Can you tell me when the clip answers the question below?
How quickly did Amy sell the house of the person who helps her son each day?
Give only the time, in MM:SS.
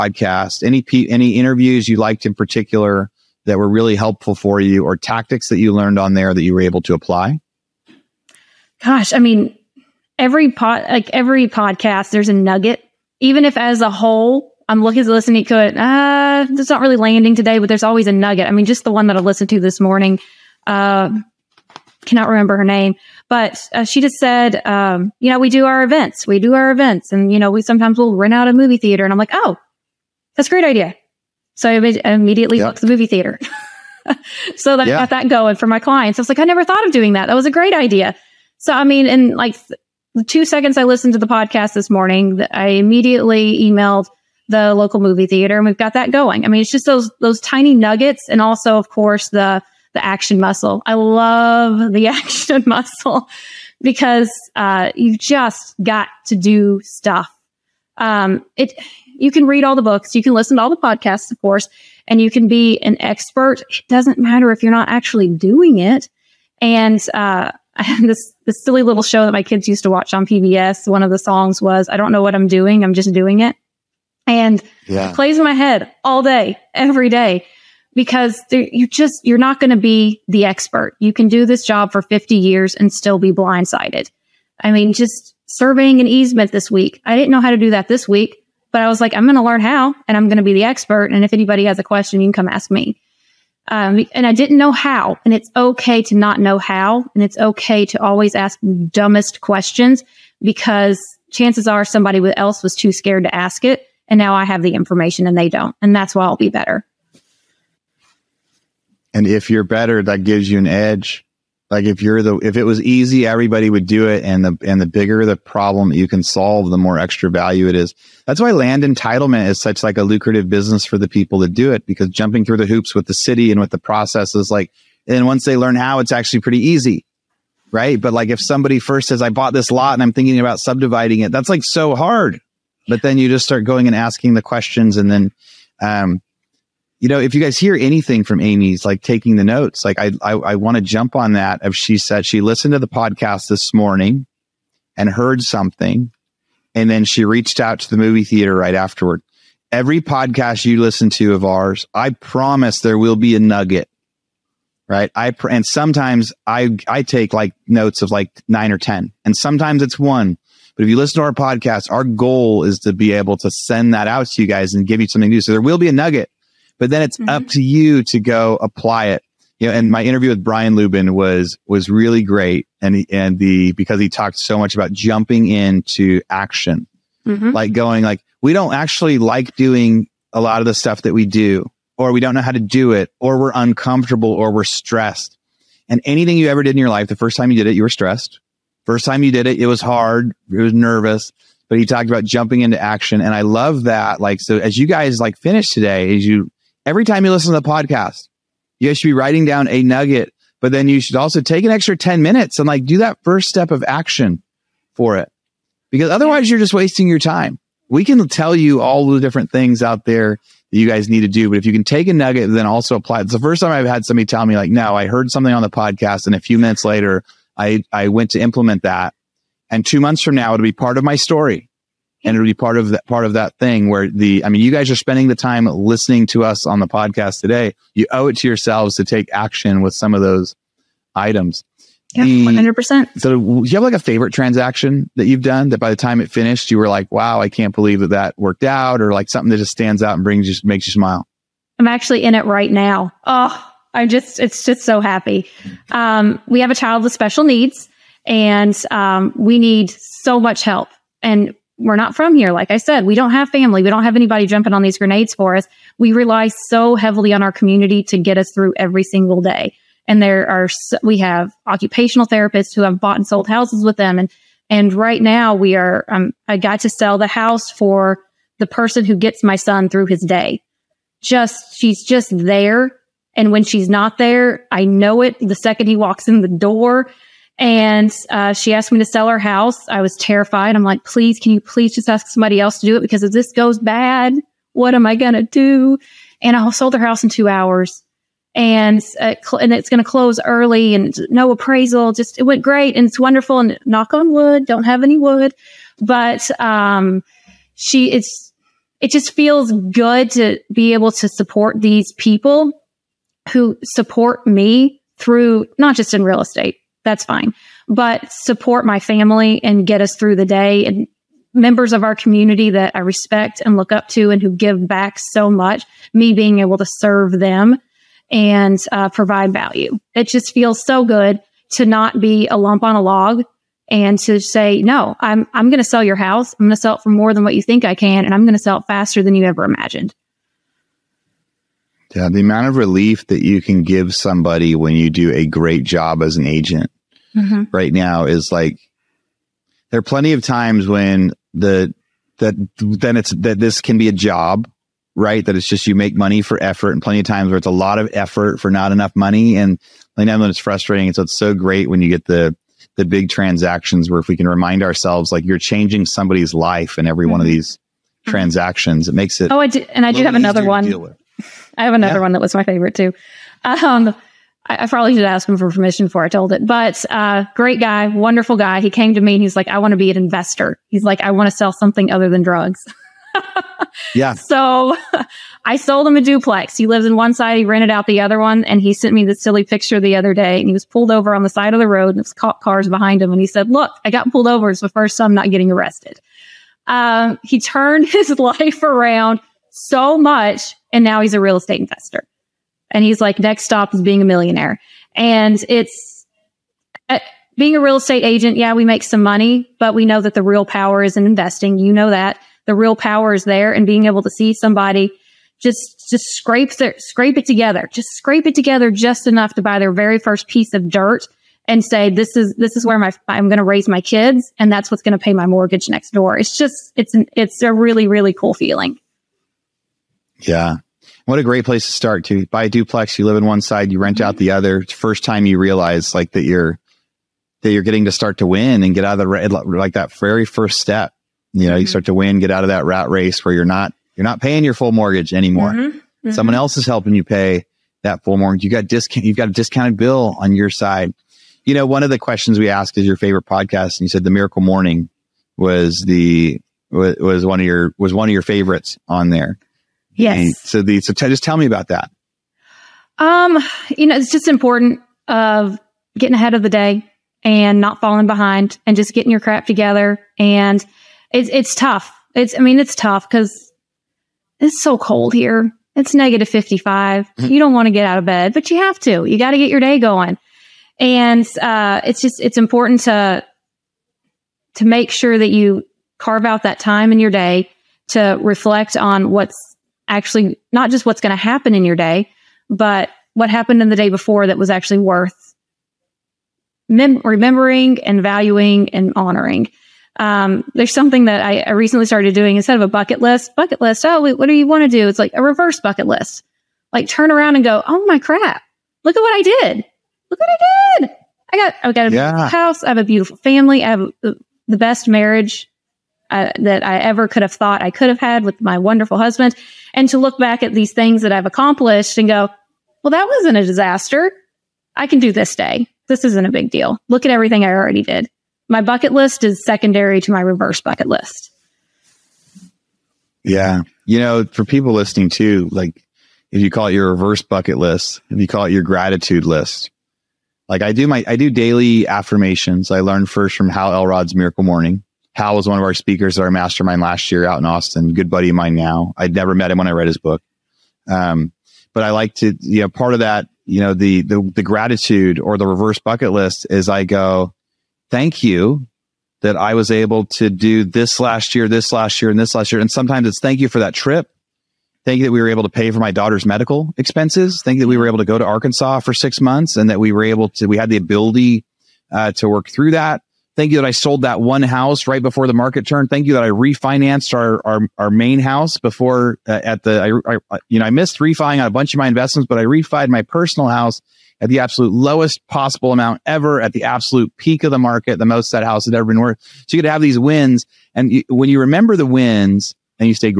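04:47.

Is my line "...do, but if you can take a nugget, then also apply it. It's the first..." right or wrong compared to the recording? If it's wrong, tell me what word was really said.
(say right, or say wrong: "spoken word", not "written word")
right.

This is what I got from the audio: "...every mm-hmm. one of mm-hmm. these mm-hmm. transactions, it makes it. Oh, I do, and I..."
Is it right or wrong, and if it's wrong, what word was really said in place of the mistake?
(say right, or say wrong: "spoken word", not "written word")
right.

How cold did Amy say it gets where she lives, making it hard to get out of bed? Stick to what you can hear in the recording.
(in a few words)
-55.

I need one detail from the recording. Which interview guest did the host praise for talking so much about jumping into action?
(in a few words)
Brian Lubin.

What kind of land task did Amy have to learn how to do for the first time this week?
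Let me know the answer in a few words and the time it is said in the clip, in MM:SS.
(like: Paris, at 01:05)
surveying an easement, at 01:25.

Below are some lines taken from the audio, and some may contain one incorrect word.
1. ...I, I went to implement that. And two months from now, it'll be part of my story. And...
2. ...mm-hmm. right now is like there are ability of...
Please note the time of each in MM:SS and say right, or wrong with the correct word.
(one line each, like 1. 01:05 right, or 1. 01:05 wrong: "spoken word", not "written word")
1. 03:37 right
2. 05:37 wrong: "plenty", not "ability".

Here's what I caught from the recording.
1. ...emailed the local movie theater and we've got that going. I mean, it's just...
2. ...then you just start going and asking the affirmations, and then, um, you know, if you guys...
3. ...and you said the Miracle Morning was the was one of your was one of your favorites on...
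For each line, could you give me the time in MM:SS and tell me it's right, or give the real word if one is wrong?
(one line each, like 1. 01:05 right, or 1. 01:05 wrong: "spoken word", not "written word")
1. 00:43 right
2. 02:13 wrong: "questions", not "affirmations"
3. 07:23 right.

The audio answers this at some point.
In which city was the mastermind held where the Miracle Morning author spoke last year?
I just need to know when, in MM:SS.
08:57.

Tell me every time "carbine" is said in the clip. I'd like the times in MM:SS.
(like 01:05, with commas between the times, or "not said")
not said.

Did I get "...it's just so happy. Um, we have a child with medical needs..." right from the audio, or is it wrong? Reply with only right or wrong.
wrong.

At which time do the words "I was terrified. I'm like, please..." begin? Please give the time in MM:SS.
04:39.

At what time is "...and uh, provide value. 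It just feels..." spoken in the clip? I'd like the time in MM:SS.
05:18.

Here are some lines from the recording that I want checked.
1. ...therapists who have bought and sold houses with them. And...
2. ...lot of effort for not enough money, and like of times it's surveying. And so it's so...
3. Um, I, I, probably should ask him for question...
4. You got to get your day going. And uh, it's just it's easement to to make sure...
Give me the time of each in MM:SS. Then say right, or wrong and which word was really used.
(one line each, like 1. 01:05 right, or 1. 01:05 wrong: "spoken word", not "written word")
1. 04:22 right
2. 05:47 wrong: "frustrating", not "surveying"
3. 06:03 wrong: "permission", not "question"
4. 07:49 wrong: "important", not "easement".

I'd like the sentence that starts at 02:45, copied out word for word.
So there will be a nugget, but then it's mm-hmm.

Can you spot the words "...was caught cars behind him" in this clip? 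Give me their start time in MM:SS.
06:22.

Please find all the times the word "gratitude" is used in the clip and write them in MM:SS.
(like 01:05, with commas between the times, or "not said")
08:48, 09:04.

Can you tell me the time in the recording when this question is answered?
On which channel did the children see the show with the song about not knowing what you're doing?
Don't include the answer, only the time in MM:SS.
01:10.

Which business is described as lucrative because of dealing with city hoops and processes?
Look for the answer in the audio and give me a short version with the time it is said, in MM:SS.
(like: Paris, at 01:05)
land entitlement, at 01:58.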